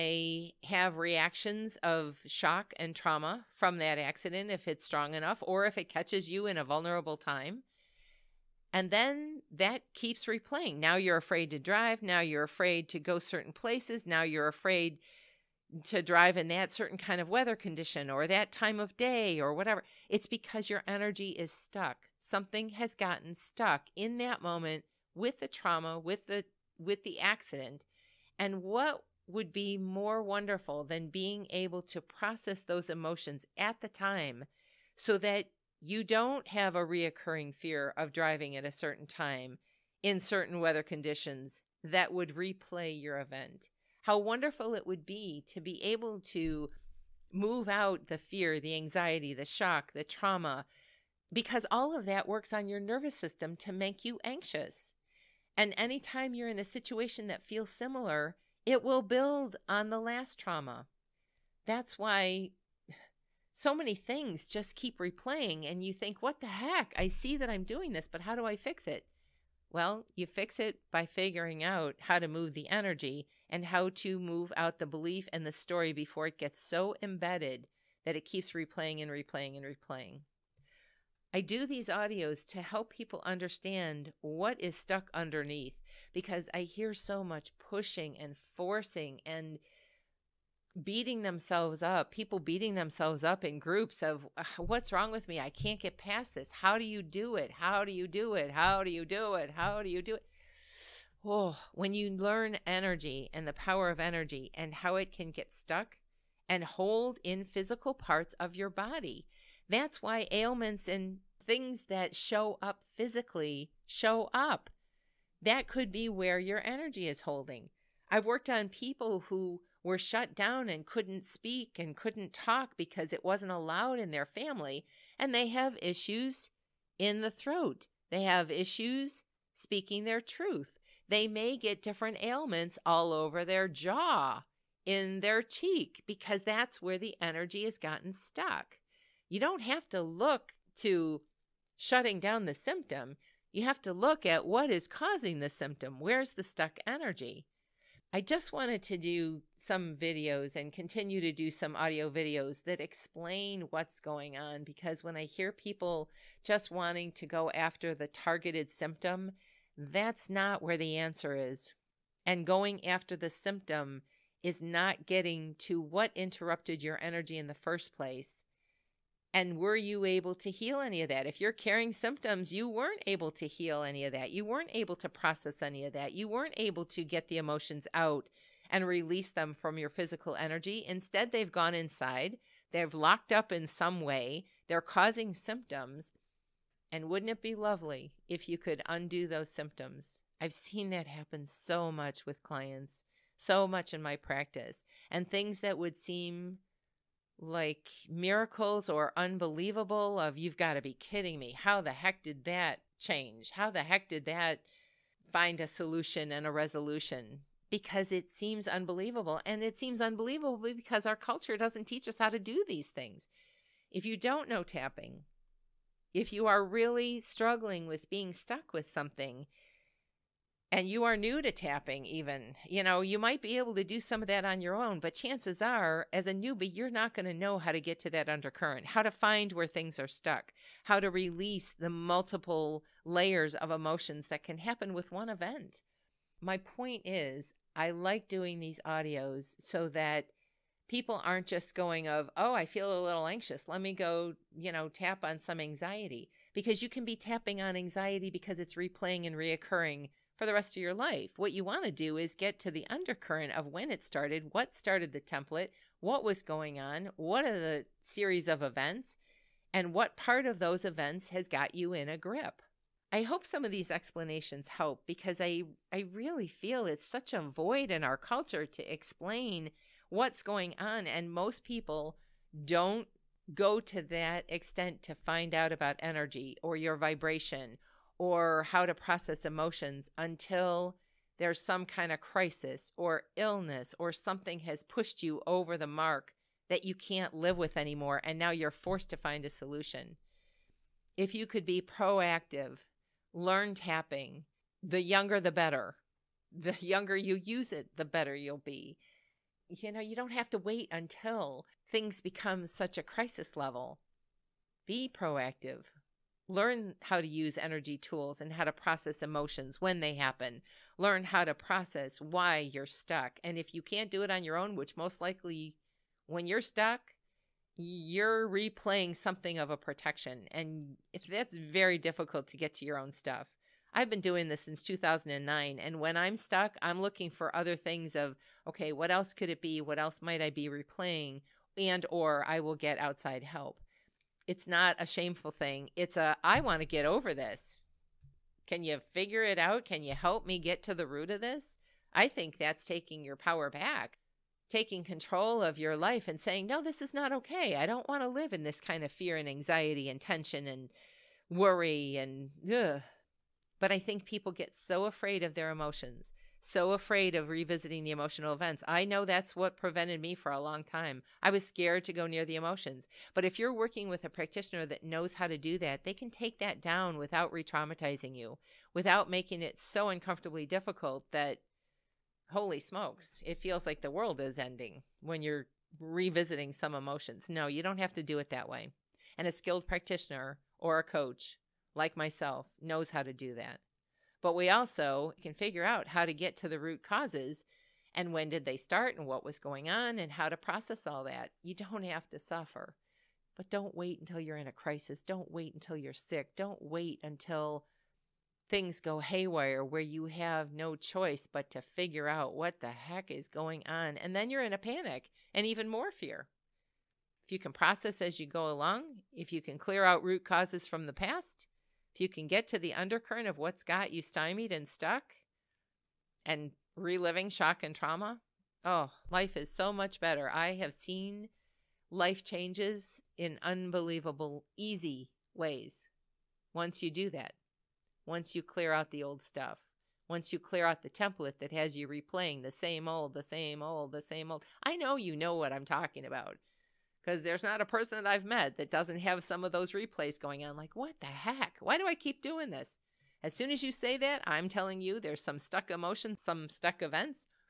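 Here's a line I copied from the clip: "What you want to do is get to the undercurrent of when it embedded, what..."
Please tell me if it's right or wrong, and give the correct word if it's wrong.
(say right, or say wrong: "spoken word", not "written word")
wrong: "started", not "embedded".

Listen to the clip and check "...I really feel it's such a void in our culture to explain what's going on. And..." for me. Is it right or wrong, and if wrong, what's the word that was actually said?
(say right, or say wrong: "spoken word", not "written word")
right.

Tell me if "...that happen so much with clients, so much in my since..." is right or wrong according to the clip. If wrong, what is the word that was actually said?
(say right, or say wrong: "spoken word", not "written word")
wrong: "practice", not "since".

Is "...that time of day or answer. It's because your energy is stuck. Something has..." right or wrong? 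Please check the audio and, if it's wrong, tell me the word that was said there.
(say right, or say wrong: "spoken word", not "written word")
wrong: "whatever", not "answer".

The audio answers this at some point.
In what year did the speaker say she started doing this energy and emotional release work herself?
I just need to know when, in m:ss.
5:24.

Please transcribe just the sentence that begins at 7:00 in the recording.
I have seen life changes in unbelievable, easy ways once you do that, once you clear out the old stuff.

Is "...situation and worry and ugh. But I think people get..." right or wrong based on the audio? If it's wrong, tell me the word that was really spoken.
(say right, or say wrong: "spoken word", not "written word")
wrong: "tension", not "situation".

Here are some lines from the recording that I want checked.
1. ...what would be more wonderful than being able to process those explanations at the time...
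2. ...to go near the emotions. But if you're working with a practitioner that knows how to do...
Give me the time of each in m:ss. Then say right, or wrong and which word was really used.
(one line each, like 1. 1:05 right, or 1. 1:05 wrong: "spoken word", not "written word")
1. 0:28 wrong: "emotions", not "explanations"
2. 6:02 right.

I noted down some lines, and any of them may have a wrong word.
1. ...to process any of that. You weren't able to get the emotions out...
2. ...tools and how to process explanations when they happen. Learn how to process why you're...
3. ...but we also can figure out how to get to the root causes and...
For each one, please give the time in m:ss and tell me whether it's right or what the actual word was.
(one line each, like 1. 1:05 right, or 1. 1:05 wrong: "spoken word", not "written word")
1. 2:54 right
2. 5:07 wrong: "emotions", not "explanations"
3. 6:24 right.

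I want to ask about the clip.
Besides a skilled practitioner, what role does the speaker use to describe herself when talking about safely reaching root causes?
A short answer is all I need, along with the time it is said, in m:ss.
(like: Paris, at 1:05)
coach, at 6:21.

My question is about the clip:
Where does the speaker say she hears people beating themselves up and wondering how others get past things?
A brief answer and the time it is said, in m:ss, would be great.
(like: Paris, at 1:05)
in groups, at 1:33.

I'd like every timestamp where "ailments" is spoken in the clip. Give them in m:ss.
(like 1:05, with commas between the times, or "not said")
1:50, 2:12.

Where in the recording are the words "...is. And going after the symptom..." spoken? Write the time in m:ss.
2:41.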